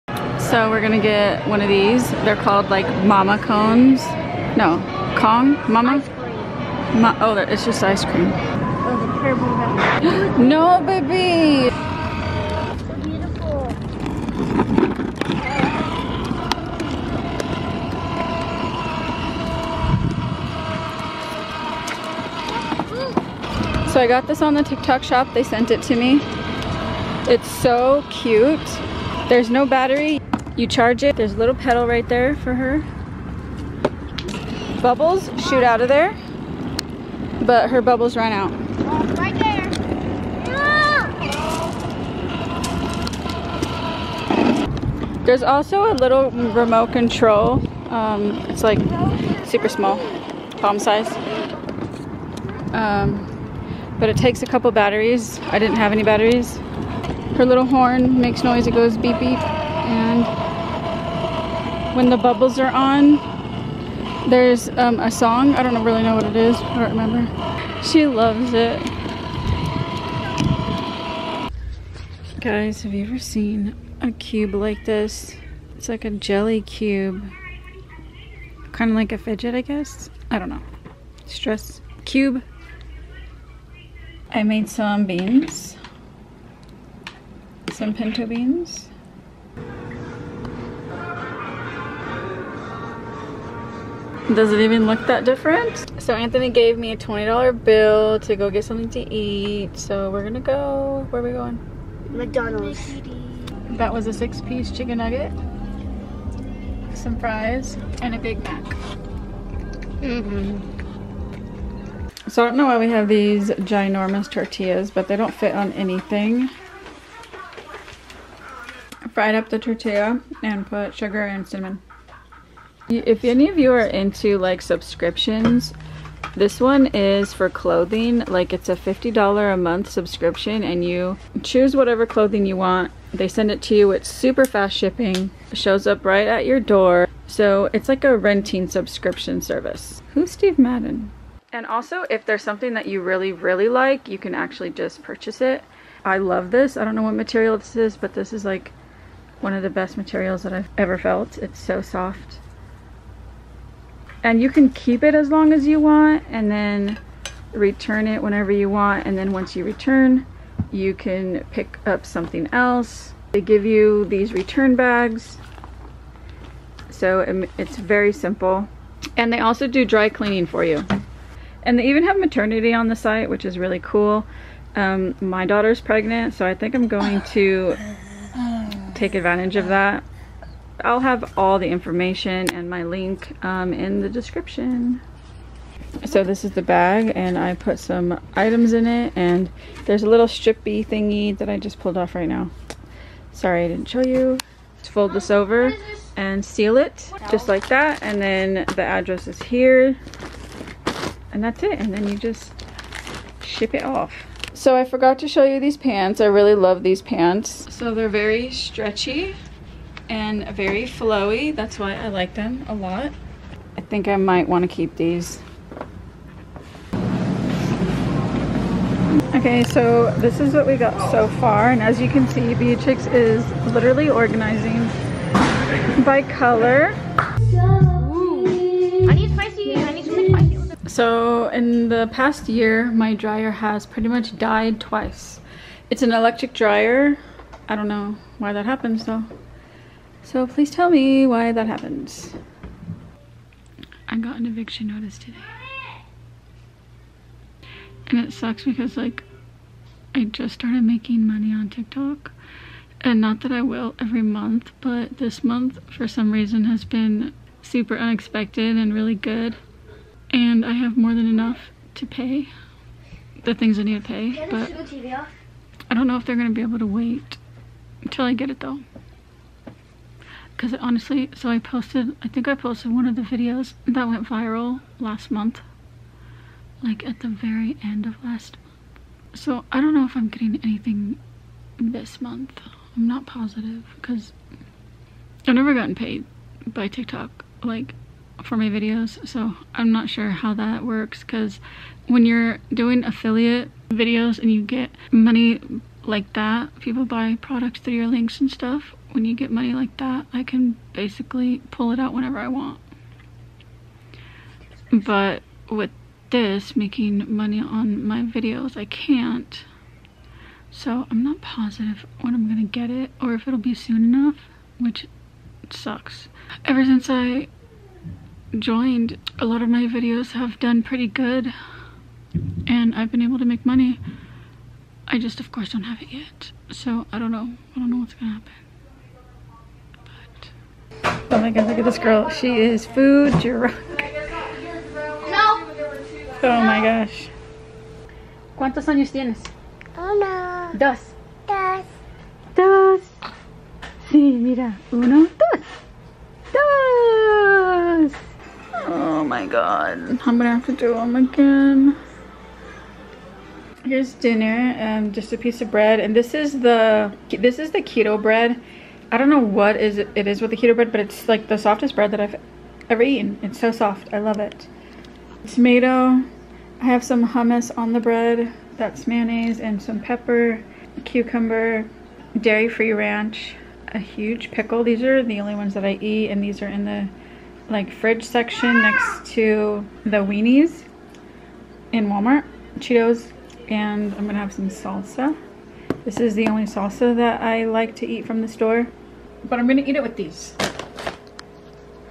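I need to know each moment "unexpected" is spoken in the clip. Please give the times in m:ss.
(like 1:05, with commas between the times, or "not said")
4:17.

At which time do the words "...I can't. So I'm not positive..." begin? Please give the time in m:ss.
5:08.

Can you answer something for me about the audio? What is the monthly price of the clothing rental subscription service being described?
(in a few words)
$50.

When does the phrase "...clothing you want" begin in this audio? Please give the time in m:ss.
2:12.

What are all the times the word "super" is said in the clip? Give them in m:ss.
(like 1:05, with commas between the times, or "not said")
0:49, 2:14, 4:17.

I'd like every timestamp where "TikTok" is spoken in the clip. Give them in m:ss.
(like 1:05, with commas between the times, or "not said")
0:24, 4:11, 4:46.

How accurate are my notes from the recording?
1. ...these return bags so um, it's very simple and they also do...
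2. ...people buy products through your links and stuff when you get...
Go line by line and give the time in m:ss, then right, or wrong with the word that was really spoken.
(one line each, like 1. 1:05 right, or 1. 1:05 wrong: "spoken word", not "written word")
1. 2:44 right
2. 4:56 right.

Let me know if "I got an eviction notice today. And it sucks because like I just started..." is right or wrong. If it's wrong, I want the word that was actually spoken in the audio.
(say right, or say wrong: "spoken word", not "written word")
right.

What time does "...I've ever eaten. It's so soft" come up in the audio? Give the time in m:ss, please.
6:02.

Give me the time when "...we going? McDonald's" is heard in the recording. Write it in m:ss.
1:41.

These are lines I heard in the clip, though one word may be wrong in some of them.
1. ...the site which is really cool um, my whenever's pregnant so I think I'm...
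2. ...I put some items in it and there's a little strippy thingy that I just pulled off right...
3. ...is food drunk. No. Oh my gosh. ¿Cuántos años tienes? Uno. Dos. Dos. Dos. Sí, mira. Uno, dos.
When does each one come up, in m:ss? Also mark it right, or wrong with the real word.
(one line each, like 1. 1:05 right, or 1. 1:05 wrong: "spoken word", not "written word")
1. 2:52 wrong: "daughter", not "whenever"
2. 3:07 right
3. 5:32 right.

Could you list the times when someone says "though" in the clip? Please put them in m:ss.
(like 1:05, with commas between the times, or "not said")
3:59, 4:28.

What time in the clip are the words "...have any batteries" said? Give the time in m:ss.
0:55.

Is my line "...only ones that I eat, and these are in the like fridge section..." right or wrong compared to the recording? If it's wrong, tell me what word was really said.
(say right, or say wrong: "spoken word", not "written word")
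right.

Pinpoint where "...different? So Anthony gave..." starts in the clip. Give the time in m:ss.
1:35.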